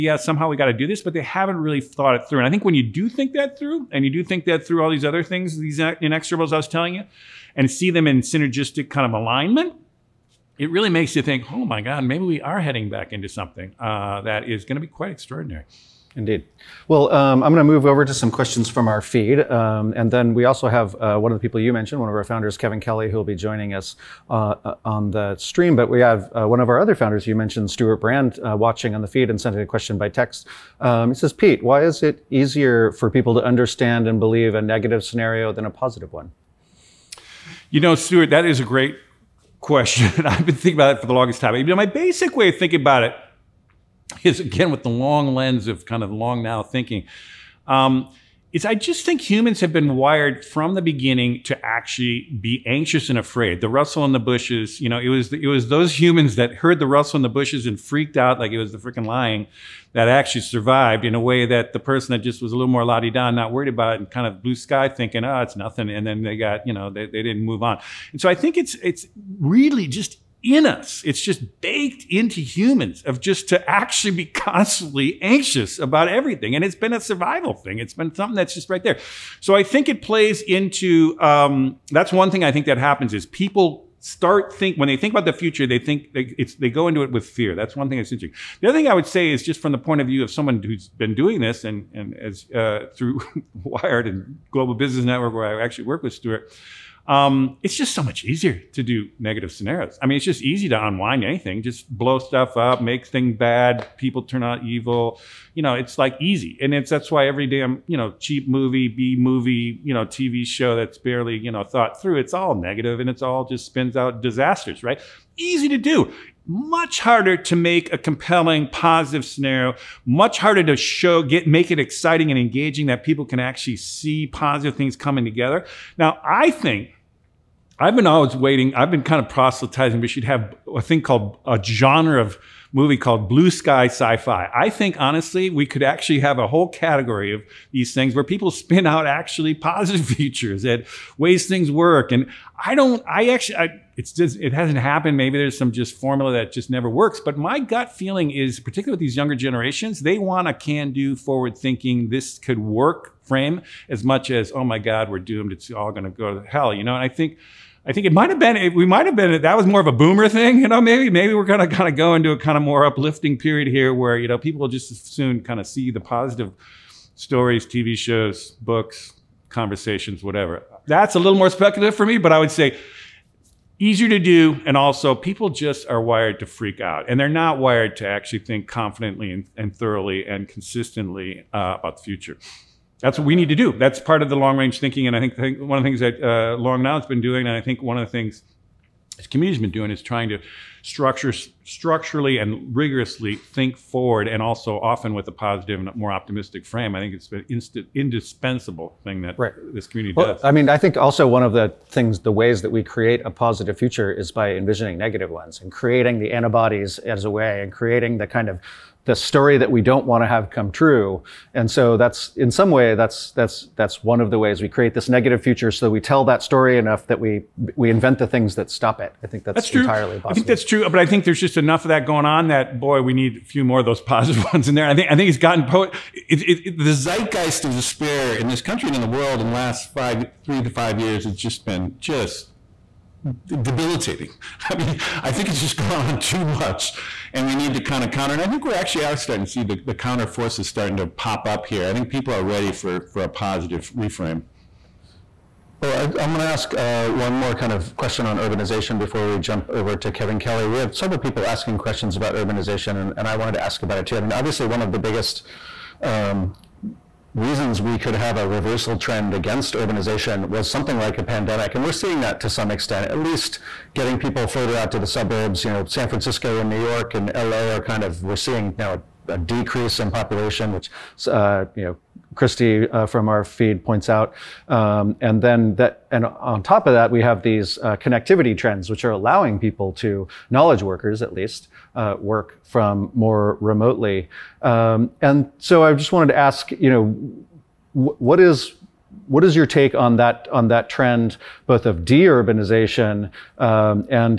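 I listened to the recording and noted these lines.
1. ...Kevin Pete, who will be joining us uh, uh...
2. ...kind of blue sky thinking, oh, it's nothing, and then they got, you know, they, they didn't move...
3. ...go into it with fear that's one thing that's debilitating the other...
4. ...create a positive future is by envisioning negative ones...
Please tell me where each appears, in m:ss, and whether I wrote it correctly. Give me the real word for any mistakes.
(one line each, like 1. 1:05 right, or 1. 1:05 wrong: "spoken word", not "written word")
1. 0:22 wrong: "Kelly", not "Pete"
2. 1:04 right
3. 1:26 wrong: "interesting", not "debilitating"
4. 3:22 right.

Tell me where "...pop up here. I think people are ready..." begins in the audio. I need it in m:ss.
4:01.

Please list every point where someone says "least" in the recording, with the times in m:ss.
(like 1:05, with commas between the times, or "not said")
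4:23, 4:41.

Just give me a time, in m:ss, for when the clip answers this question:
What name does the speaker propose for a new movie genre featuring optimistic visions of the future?
2:13.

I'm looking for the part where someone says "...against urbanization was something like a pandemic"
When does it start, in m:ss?
4:19.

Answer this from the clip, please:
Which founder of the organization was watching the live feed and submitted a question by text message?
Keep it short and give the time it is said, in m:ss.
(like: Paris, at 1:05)
Stewart Brand, at 0:27.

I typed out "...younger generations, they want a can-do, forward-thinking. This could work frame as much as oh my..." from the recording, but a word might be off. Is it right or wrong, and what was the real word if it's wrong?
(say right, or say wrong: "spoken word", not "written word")
right.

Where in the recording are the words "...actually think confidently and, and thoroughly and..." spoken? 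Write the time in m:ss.
2:58.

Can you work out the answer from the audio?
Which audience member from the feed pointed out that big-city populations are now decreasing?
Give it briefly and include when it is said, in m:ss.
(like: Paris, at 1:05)
Christy, at 4:32.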